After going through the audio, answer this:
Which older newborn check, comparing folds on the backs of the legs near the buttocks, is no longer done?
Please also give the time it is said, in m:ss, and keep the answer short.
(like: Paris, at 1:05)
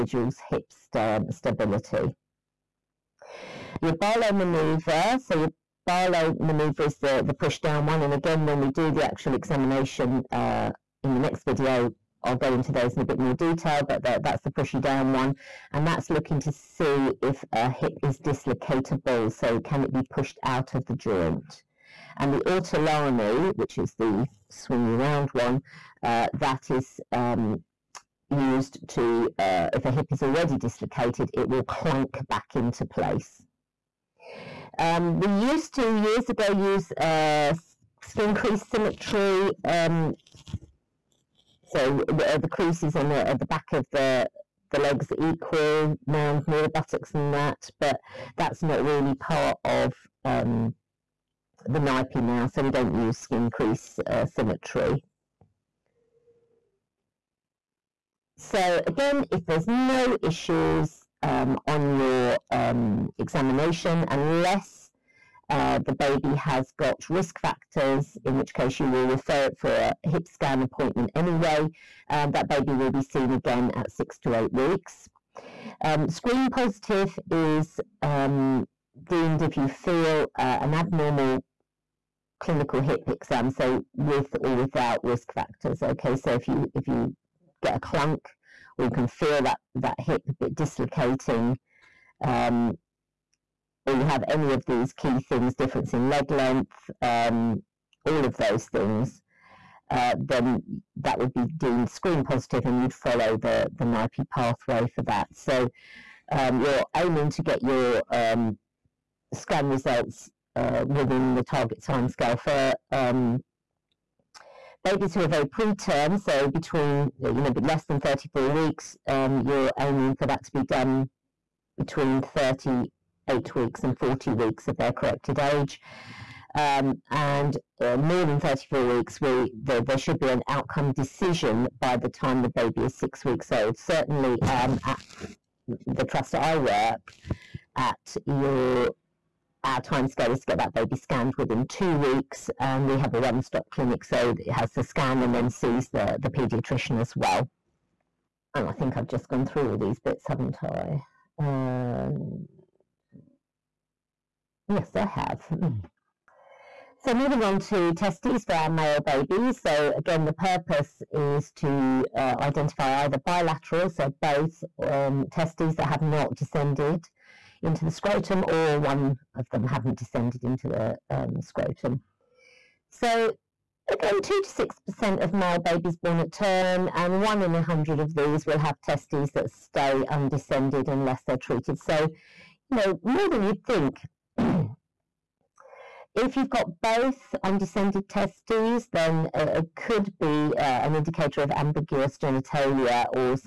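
Skin crease symmetry, at 0:38.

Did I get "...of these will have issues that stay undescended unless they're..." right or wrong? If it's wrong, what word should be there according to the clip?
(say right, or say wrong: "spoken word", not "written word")
wrong: "testes", not "issues".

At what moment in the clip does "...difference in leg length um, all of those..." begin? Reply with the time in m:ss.
1:35.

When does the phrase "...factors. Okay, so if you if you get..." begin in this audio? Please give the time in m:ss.
1:25.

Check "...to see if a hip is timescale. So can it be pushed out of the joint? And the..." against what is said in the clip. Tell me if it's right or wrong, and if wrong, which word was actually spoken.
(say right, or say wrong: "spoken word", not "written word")
wrong: "dislocatable", not "timescale".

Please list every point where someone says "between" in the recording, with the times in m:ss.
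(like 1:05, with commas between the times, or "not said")
1:56, 2:01.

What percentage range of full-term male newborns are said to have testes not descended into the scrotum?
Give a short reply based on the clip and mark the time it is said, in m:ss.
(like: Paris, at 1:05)
2 to 6%, at 2:54.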